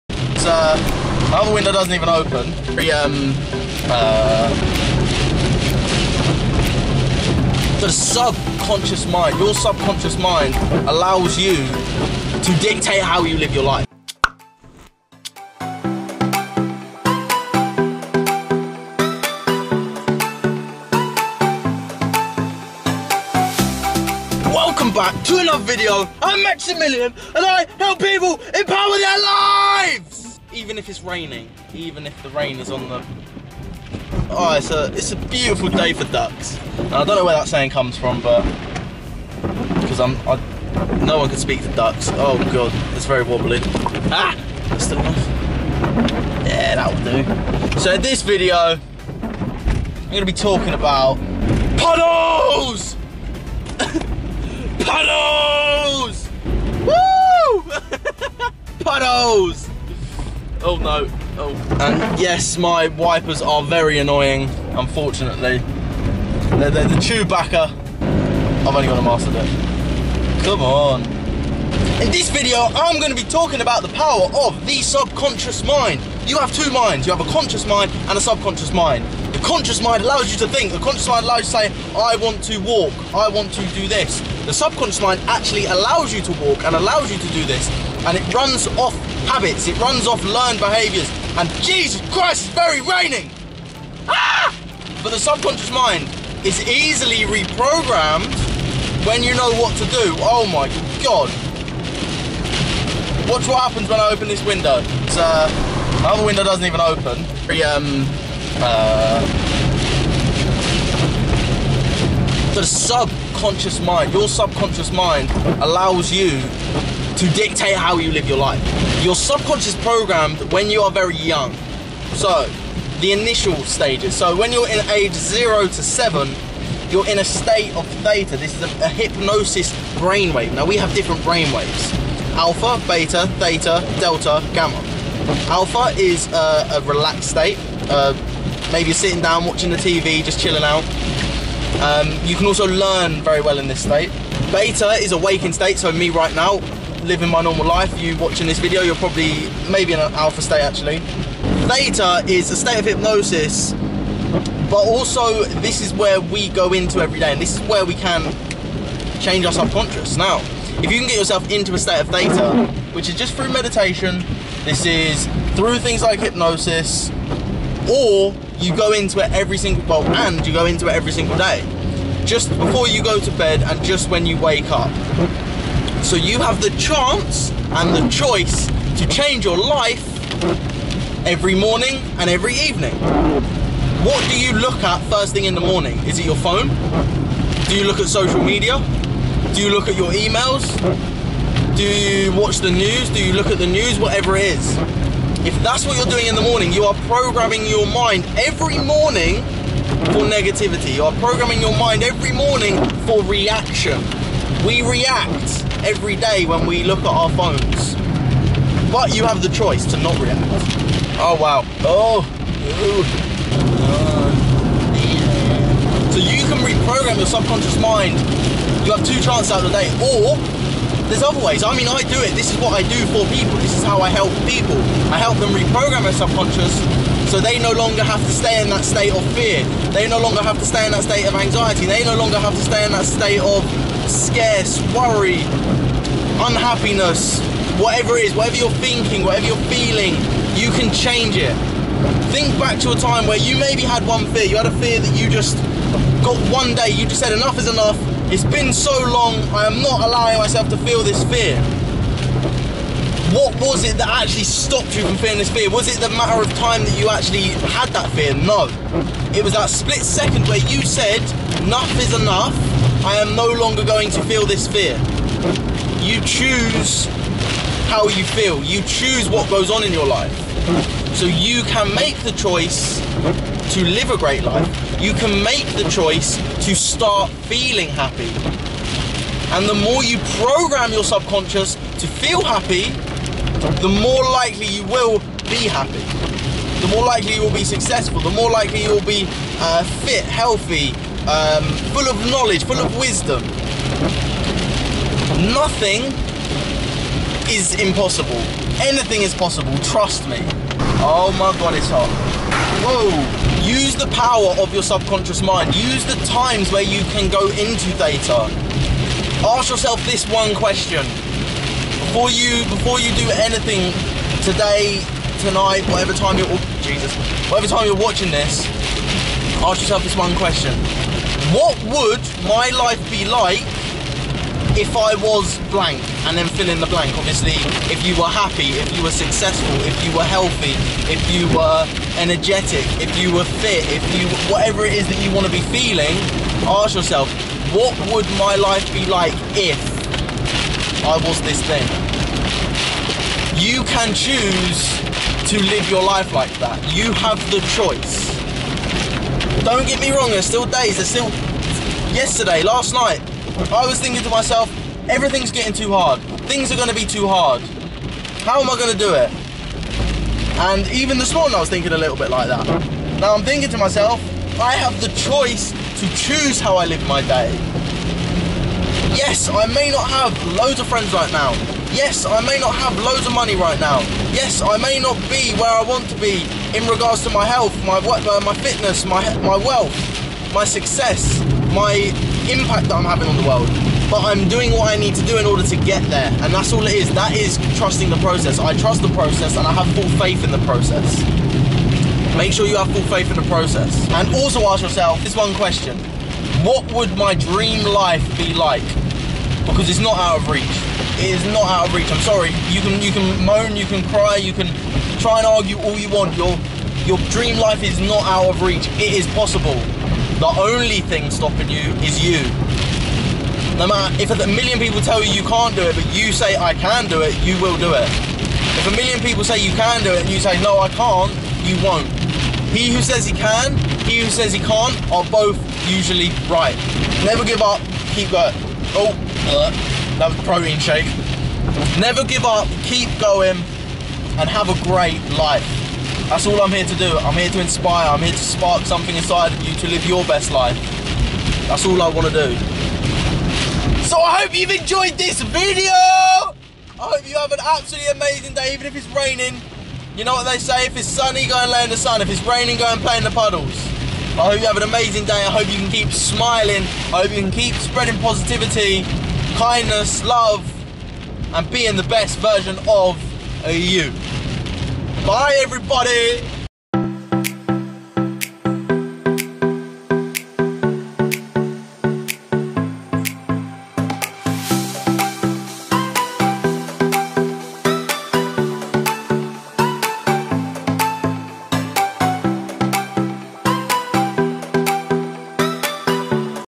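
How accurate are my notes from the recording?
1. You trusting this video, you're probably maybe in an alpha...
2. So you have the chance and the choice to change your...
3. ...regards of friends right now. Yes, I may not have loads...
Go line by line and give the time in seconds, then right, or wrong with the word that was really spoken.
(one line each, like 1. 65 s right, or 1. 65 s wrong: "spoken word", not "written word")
1. 147 s wrong: "watching", not "trusting"
2. 176 s right
3. 370 s wrong: "loads", not "regards".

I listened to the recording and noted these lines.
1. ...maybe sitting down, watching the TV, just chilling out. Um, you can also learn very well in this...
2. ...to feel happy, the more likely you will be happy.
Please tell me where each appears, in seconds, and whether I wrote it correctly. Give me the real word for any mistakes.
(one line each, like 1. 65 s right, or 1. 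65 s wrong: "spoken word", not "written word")
1. 138 s right
2. 282 s right.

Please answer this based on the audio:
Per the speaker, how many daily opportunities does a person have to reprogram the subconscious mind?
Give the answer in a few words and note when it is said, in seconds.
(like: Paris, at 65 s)
2, at 219 s.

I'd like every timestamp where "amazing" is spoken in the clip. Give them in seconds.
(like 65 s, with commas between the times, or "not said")
448 s, 454 s.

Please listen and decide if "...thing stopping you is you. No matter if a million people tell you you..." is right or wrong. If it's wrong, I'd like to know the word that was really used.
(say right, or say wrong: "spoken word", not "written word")
right.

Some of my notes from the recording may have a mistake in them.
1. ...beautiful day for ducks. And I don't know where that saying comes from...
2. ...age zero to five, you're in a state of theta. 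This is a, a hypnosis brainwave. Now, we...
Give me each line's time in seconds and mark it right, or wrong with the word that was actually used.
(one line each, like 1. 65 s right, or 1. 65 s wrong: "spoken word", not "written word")
1. 35 s right
2. 124 s wrong: "seven", not "five".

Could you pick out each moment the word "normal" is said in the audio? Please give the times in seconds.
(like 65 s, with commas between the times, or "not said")
147 s.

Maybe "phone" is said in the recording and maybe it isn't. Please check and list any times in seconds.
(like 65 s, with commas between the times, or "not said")
186 s, 207 s.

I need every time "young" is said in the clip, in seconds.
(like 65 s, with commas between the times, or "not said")
121 s.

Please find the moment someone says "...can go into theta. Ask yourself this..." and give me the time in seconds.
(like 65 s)
307 s.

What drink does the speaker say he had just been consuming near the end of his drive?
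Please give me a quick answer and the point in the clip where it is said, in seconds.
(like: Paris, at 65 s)
Protein shake, at 430 s.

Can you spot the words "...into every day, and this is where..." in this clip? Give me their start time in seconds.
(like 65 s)
156 s.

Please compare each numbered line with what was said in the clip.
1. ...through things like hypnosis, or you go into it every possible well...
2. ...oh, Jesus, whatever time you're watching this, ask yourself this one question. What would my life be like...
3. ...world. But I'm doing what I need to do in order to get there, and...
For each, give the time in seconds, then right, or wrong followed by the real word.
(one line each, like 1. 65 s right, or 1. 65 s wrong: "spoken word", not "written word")
1. 165 s wrong: "single", not "possible"
2. 316 s right
3. 383 s right.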